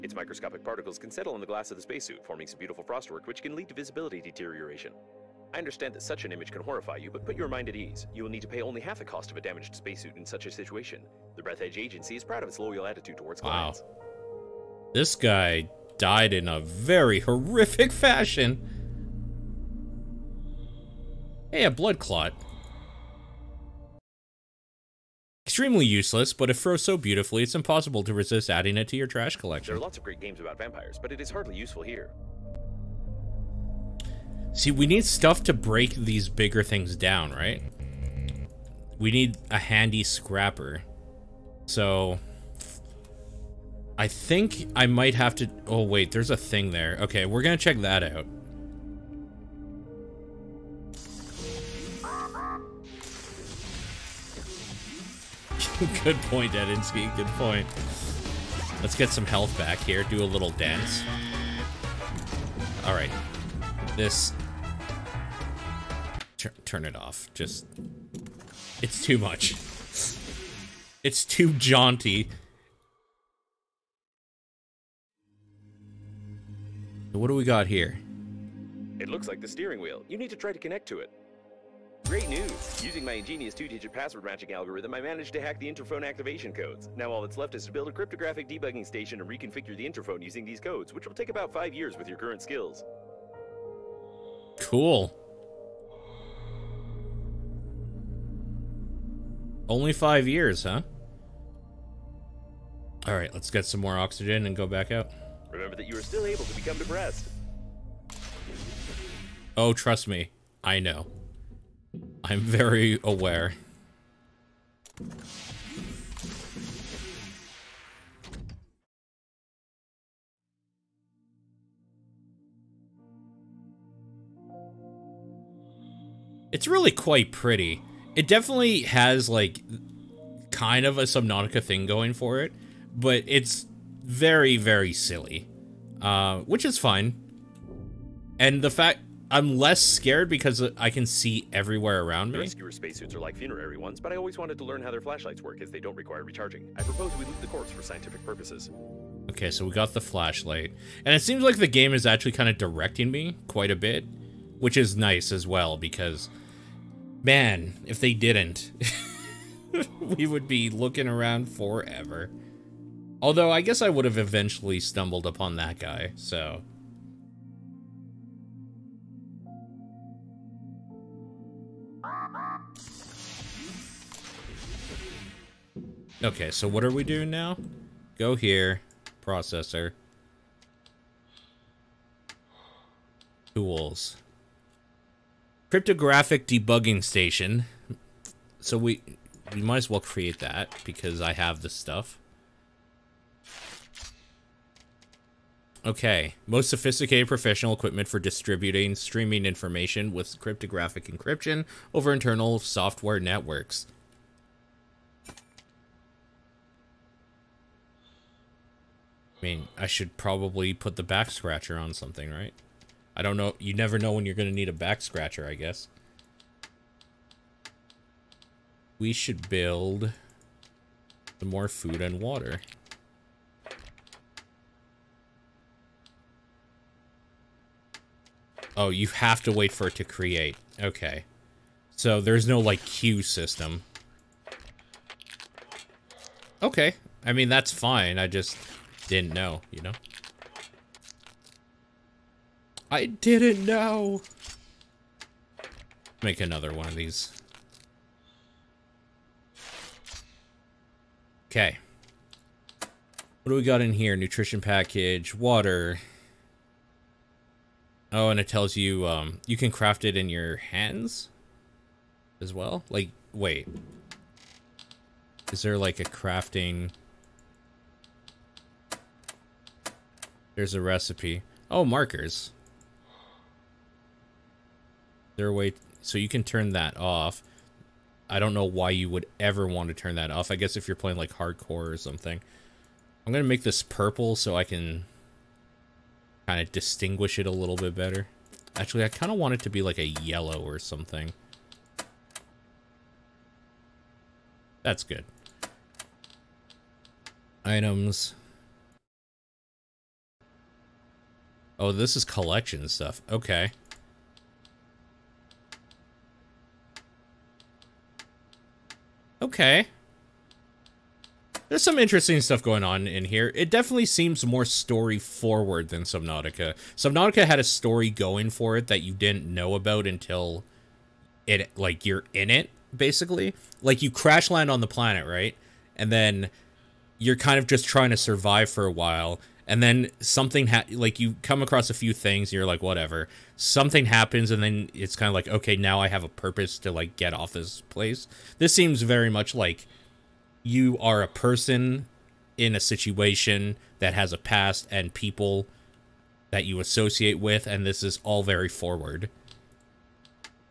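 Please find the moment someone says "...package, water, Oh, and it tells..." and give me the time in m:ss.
4:14.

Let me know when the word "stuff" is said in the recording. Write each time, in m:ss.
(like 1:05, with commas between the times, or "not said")
0:35, 3:11, 5:02, 5:12.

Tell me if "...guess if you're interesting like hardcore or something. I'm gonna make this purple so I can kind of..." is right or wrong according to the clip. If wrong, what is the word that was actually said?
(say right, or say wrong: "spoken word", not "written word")
wrong: "playing", not "interesting".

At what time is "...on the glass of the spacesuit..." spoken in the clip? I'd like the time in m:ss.
0:01.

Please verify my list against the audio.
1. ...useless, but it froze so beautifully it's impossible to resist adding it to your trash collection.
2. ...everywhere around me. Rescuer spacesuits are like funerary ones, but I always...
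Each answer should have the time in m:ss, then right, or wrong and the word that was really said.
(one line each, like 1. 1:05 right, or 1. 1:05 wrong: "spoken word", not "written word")
1. 0:25 right
2. 2:21 right.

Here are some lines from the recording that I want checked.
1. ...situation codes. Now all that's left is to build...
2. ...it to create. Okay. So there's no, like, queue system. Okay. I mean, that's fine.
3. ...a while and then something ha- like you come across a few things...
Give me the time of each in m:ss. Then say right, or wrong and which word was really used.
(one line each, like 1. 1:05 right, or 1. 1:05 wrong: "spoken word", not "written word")
1. 1:26 wrong: "activation", not "situation"
2. 3:49 right
3. 5:28 right.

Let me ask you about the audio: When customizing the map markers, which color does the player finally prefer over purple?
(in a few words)
yellow.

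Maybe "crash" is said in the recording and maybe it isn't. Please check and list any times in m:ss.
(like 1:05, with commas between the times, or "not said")
5:24.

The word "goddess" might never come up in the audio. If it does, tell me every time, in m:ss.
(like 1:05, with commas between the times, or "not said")
not said.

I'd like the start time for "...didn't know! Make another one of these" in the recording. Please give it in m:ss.
4:03.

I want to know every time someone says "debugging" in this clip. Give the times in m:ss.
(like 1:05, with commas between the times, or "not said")
1:28, 3:06.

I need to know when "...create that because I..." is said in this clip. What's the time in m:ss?
3:09.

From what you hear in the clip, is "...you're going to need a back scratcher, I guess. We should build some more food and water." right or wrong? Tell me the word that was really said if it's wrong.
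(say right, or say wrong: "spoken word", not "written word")
right.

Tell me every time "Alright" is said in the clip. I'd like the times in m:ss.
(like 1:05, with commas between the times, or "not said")
1:43.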